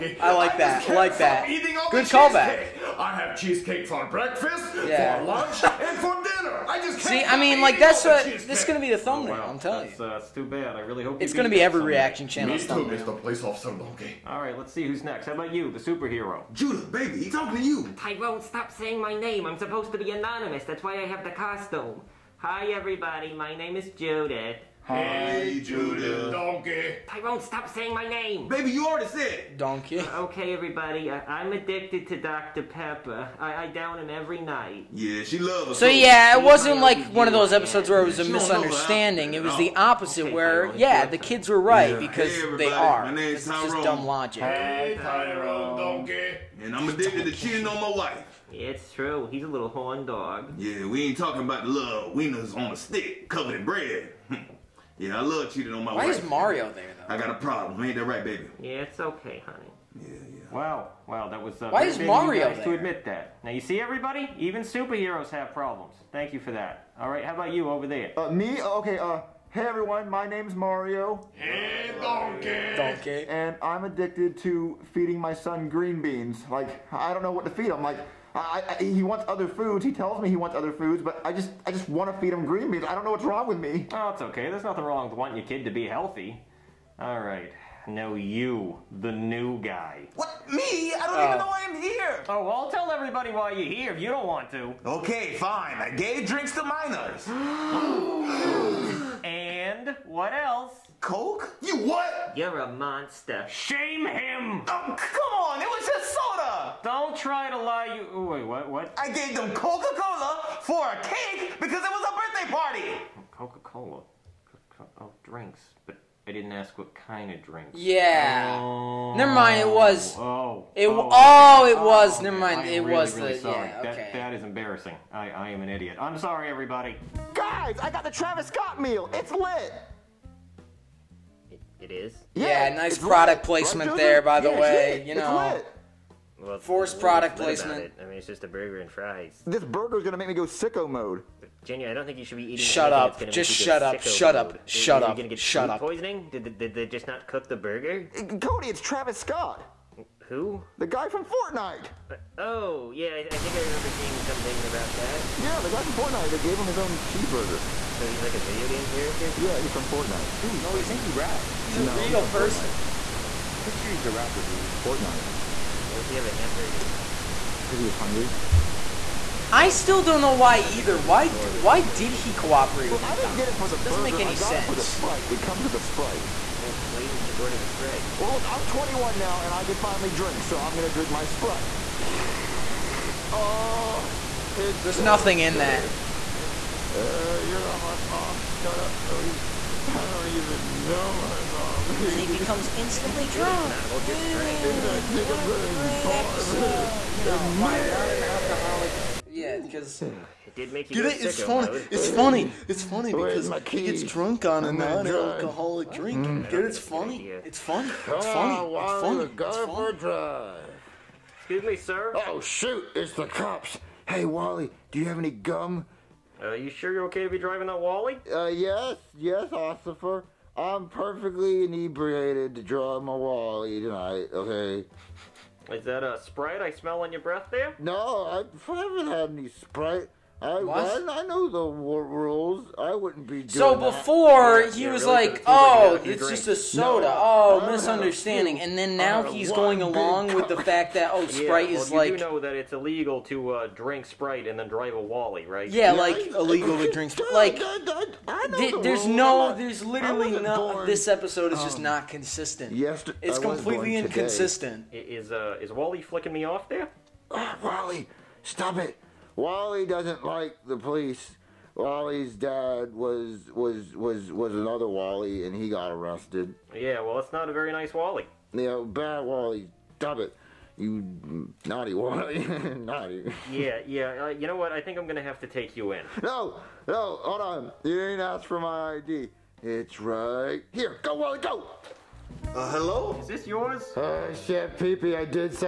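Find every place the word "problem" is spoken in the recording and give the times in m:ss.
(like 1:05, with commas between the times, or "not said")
0:57, 1:05.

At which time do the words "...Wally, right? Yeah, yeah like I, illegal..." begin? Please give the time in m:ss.
4:05.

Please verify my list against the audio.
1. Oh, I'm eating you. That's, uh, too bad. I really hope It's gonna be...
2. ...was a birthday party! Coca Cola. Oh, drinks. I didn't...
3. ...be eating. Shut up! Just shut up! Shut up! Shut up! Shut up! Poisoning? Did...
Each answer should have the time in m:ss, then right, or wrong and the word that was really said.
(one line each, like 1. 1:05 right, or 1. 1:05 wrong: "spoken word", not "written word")
1. 0:09 wrong: "telling", not "eating"
2. 1:51 right
3. 2:22 right.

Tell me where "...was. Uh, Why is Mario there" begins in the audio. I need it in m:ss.
1:01.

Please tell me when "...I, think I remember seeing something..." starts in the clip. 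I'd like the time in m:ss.
2:33.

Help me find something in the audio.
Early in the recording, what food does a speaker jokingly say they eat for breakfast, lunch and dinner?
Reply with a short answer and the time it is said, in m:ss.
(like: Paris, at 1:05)
Cheesecake, at 0:03.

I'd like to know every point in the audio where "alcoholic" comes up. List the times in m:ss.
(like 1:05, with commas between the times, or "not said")
3:18, 3:24.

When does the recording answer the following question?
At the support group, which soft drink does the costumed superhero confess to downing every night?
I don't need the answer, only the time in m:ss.
0:32.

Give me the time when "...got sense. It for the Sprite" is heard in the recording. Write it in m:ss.
2:54.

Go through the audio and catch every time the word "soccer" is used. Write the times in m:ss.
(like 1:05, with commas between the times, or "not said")
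not said.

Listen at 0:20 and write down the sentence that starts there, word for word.
That's why I have the costume.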